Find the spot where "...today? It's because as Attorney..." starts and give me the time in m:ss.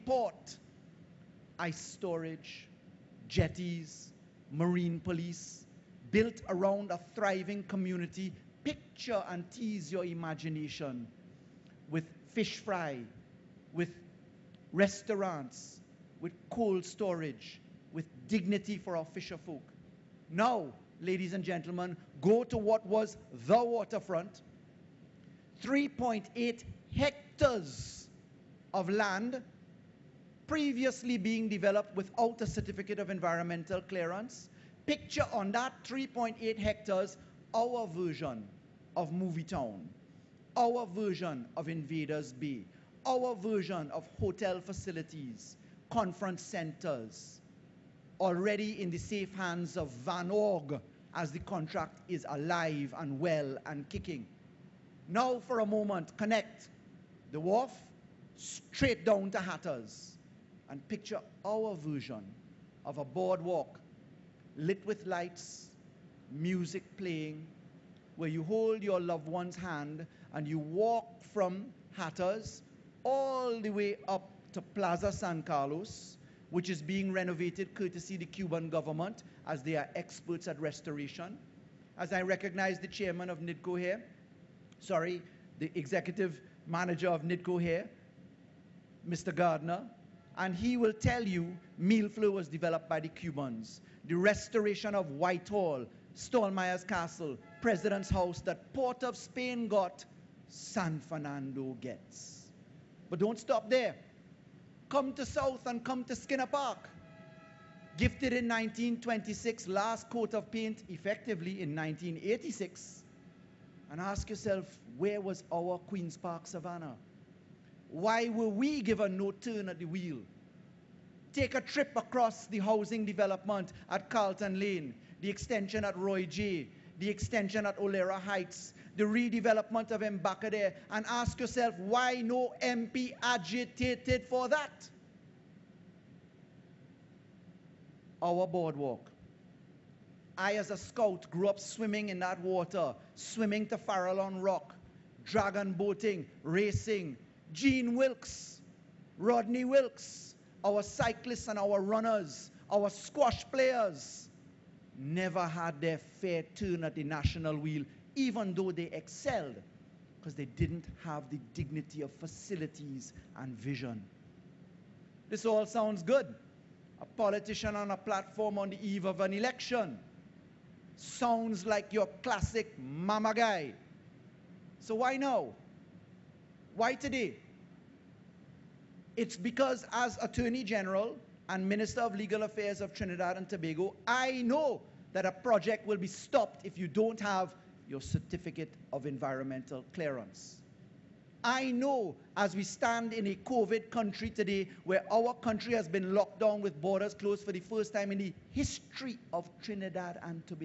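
2:56.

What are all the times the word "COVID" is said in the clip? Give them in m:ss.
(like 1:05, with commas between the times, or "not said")
3:13.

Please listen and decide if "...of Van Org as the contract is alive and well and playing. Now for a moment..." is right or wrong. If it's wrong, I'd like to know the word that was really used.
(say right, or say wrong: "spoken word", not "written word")
wrong: "kicking", not "playing".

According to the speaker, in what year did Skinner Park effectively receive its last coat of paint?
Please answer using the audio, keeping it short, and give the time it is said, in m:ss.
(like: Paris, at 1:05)
1986, at 1:51.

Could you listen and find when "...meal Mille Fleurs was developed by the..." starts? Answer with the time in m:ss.
1:31.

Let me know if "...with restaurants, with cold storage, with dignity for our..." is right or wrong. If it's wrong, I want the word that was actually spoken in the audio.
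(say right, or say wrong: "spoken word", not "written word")
right.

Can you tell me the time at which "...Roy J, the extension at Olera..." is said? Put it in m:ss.
2:05.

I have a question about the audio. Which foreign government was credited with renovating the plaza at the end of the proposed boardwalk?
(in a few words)
Cuban government.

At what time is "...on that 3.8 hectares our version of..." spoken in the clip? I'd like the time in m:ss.
0:35.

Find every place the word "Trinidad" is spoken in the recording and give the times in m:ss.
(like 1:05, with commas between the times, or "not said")
3:02, 3:19.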